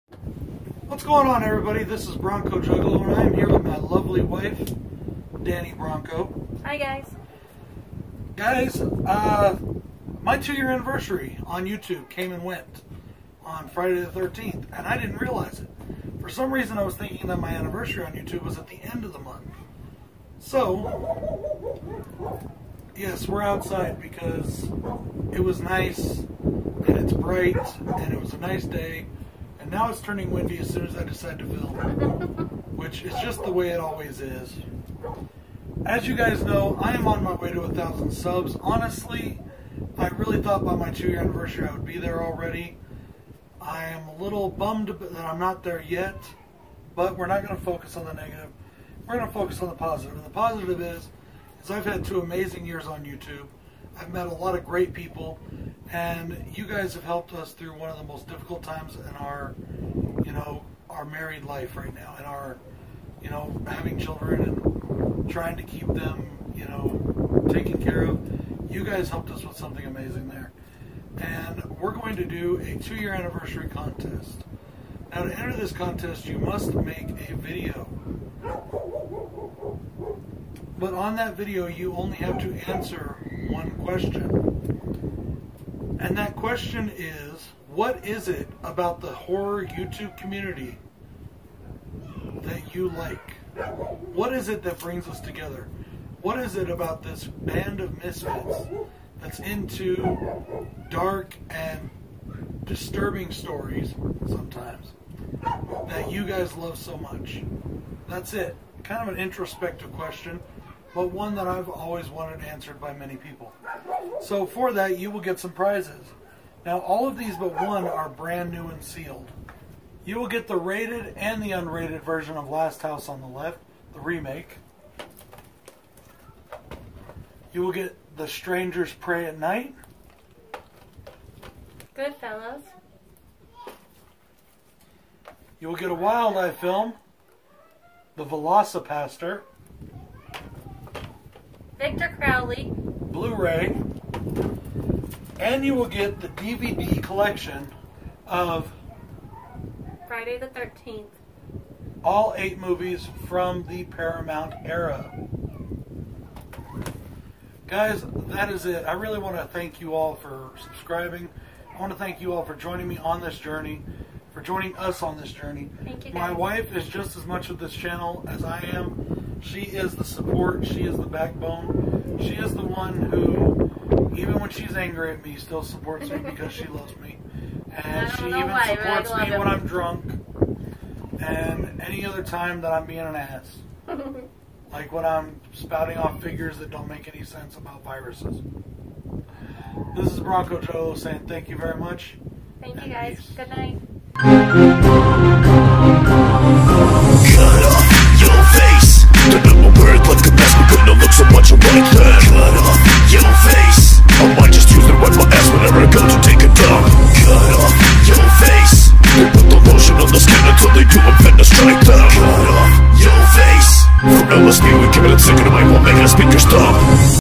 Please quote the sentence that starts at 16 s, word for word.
For some reason, I was thinking that my anniversary on YouTube was at the end of the month.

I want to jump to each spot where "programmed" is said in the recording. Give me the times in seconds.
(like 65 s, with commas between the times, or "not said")
not said.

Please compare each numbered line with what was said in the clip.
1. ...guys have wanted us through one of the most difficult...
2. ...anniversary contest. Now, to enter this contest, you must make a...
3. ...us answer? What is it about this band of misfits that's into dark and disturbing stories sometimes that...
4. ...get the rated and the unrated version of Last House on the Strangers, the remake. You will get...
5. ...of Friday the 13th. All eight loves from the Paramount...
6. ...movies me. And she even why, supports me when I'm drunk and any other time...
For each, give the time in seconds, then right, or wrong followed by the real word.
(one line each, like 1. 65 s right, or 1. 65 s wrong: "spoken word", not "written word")
1. 56 s wrong: "helped", not "wanted"
2. 73 s right
3. 95 s wrong: "together", not "answer"
4. 120 s wrong: "Left", not "Strangers"
5. 148 s wrong: "movies", not "loves"
6. 176 s wrong: "loves", not "movies".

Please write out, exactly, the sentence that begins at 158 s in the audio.
I really want to thank you all for subscribing.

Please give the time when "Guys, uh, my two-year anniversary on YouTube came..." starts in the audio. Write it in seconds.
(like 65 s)
8 s.